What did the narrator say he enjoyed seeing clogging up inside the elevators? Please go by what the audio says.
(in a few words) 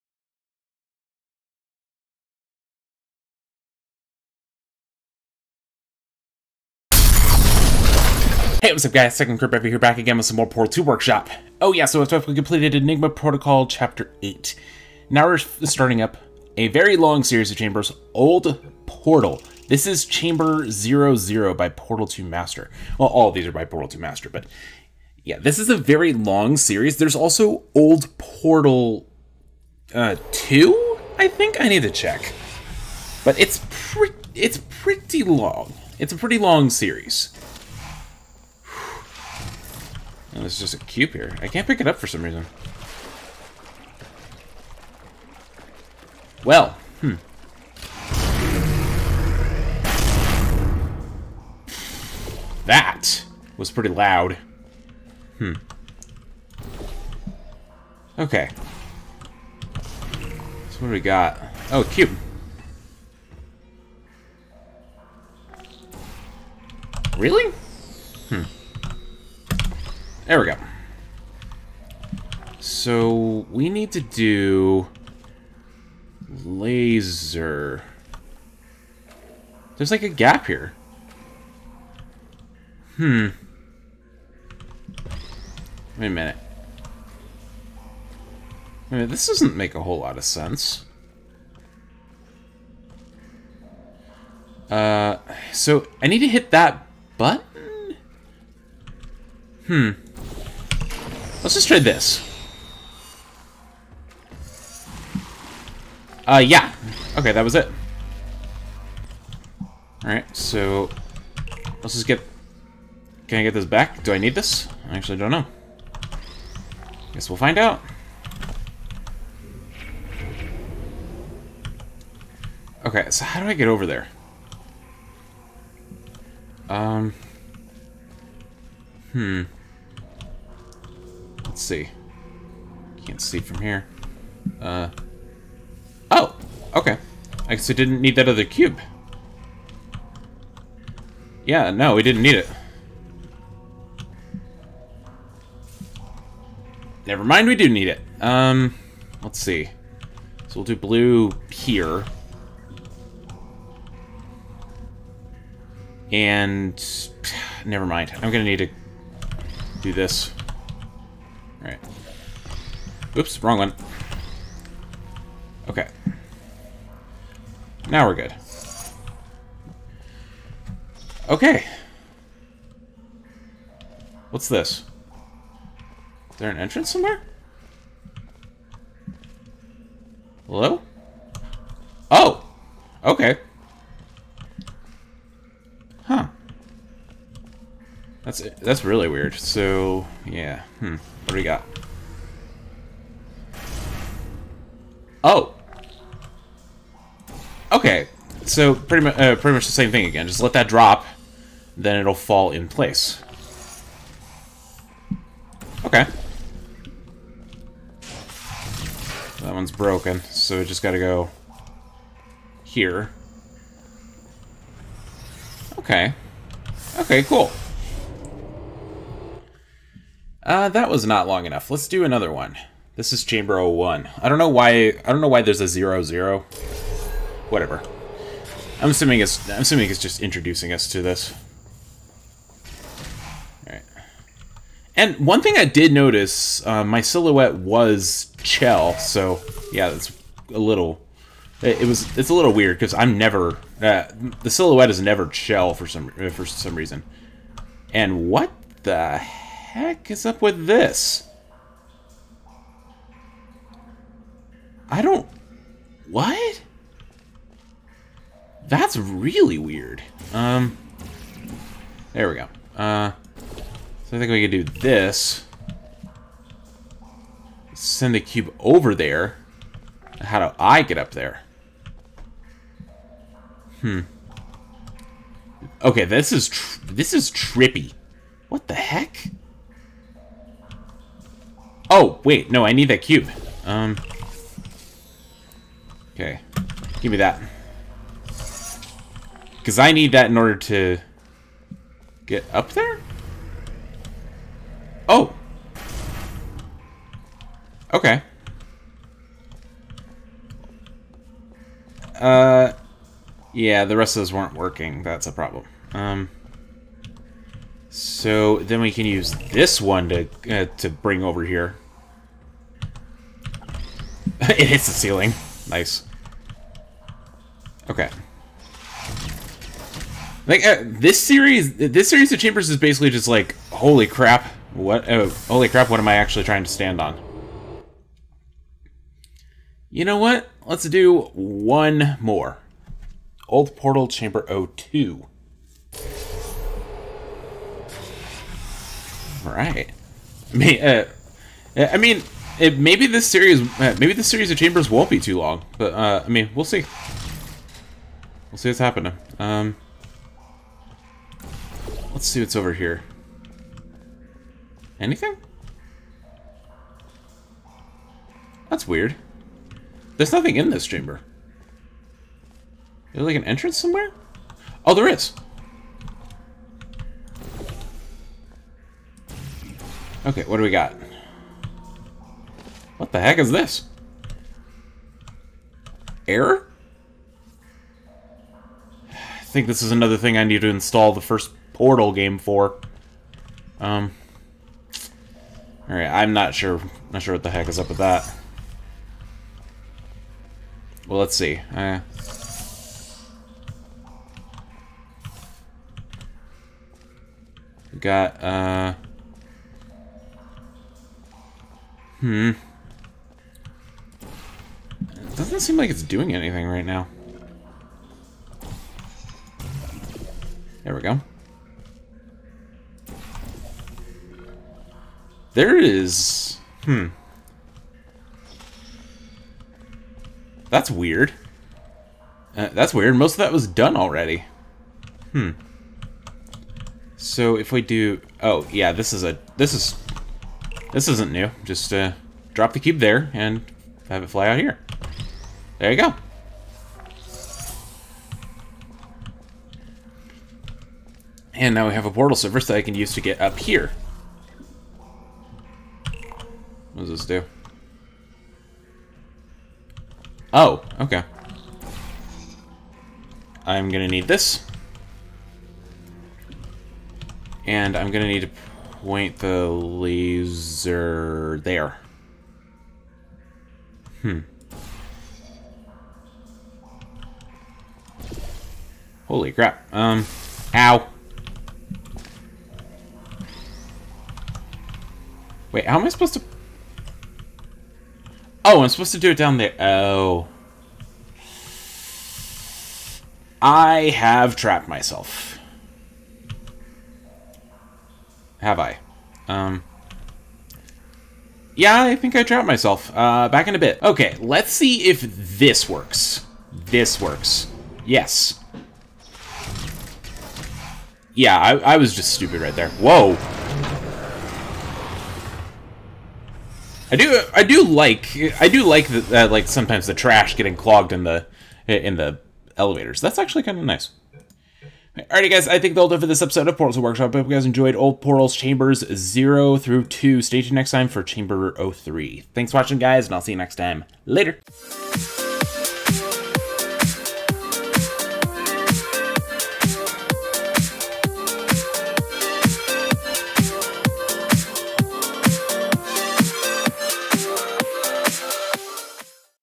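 trash.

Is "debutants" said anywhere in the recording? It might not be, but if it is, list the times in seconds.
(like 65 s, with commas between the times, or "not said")
not said.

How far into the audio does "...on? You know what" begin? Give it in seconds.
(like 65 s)
326 s.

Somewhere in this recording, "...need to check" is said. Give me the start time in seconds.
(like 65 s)
31 s.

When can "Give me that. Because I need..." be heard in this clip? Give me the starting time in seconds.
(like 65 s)
287 s.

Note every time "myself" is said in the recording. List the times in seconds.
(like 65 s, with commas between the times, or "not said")
484 s, 492 s.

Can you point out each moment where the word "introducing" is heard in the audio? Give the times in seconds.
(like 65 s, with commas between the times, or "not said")
230 s.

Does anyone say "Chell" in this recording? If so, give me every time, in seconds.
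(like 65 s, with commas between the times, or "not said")
238 s, 245 s.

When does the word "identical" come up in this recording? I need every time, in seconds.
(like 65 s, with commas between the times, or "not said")
not said.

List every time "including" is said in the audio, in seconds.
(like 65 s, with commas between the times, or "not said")
not said.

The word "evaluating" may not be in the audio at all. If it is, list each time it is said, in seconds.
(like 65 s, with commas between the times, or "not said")
not said.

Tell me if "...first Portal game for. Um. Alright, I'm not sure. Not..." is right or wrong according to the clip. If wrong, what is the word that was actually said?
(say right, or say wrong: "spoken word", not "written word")
right.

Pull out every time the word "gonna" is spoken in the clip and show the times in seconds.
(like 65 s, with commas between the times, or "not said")
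158 s, 453 s, 458 s.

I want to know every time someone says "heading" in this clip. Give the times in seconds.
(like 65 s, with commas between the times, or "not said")
not said.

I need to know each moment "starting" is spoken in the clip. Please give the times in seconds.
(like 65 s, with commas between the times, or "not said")
15 s.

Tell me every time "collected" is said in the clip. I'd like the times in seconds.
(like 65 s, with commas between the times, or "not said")
not said.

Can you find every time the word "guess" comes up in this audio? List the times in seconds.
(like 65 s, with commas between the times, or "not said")
117 s, 137 s.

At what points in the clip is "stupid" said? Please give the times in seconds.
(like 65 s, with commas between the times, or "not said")
502 s.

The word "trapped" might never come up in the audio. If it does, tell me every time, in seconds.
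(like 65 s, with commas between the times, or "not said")
484 s, 492 s.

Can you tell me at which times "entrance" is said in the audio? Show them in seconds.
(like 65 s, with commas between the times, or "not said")
176 s, 363 s.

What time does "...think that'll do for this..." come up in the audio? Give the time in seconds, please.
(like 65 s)
515 s.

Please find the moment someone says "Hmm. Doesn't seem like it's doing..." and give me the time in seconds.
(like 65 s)
402 s.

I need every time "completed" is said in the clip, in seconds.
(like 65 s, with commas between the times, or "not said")
12 s.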